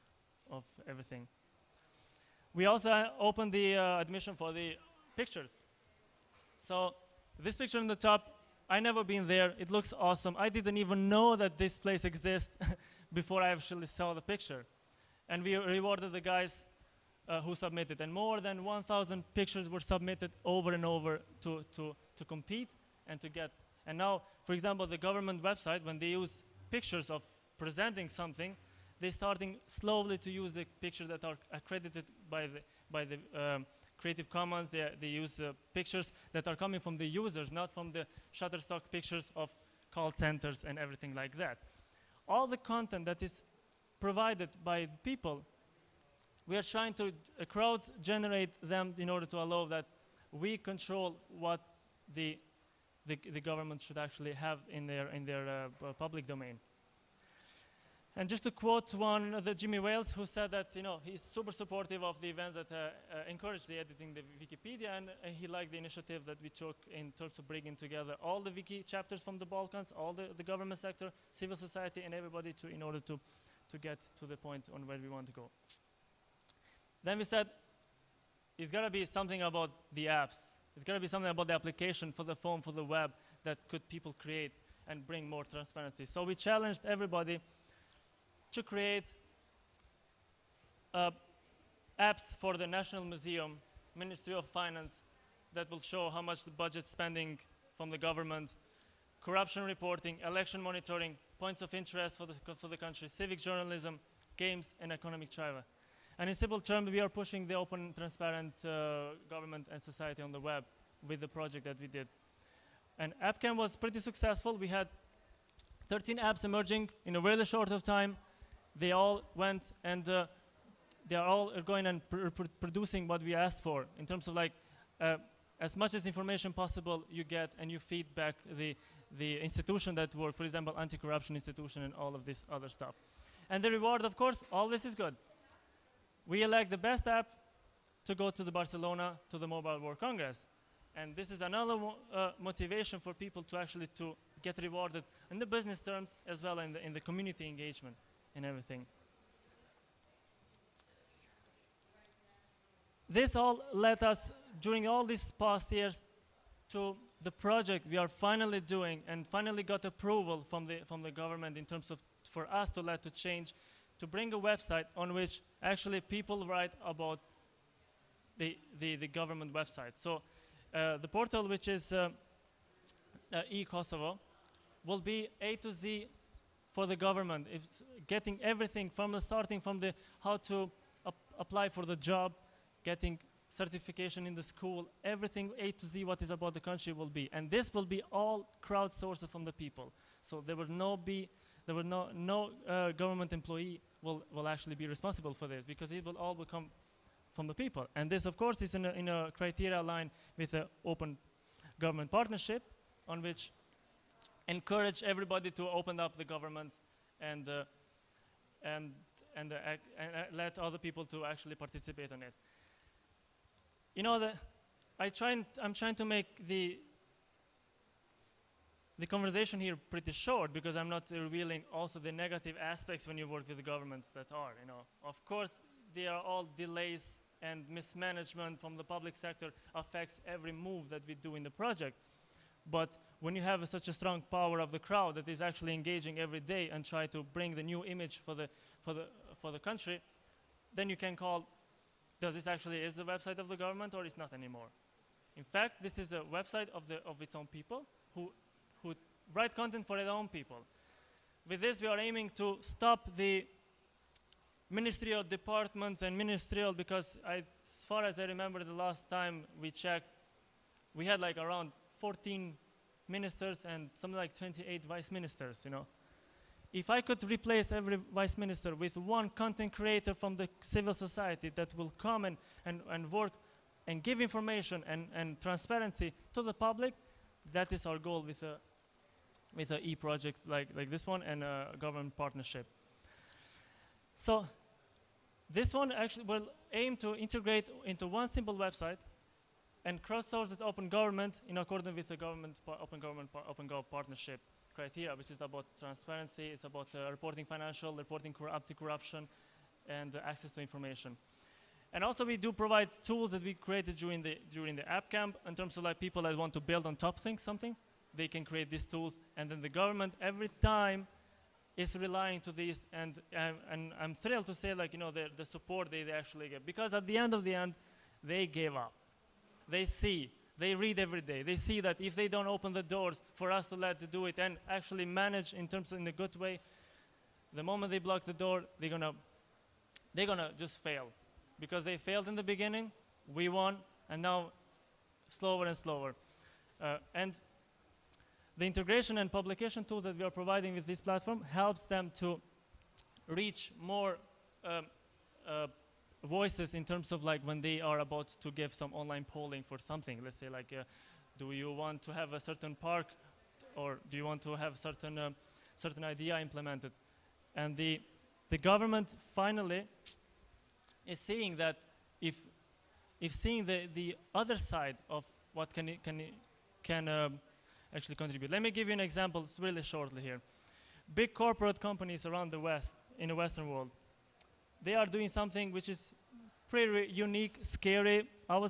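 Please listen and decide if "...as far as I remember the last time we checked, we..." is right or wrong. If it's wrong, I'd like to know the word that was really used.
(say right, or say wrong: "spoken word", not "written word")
right.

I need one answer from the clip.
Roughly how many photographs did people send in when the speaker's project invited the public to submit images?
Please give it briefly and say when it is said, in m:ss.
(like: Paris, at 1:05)
More than 1,000, at 0:18.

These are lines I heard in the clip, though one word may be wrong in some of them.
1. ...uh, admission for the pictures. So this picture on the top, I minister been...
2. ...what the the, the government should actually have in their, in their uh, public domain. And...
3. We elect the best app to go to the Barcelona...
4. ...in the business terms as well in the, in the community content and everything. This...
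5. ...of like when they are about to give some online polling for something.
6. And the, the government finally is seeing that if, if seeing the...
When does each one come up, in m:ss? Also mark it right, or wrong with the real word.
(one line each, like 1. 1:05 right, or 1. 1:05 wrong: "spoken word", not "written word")
1. 0:03 wrong: "never", not "minister"
2. 0:51 right
3. 2:16 right
4. 2:25 wrong: "engagement", not "content"
5. 5:47 right
6. 5:57 right.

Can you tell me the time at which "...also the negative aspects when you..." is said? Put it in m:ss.
3:41.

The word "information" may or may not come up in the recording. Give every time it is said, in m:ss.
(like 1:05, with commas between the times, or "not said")
2:06, 4:34, 5:00.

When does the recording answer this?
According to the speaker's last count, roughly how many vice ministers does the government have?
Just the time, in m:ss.
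4:24.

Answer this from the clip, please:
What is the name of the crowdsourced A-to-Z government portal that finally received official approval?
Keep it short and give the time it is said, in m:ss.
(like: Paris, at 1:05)
eKosovo, at 2:53.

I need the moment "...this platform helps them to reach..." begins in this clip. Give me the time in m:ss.
5:40.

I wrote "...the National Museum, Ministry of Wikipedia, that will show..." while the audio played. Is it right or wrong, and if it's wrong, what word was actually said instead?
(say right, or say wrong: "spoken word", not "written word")
wrong: "Finance", not "Wikipedia".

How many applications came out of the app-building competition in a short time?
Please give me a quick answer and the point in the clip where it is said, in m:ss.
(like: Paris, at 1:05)
13, at 1:55.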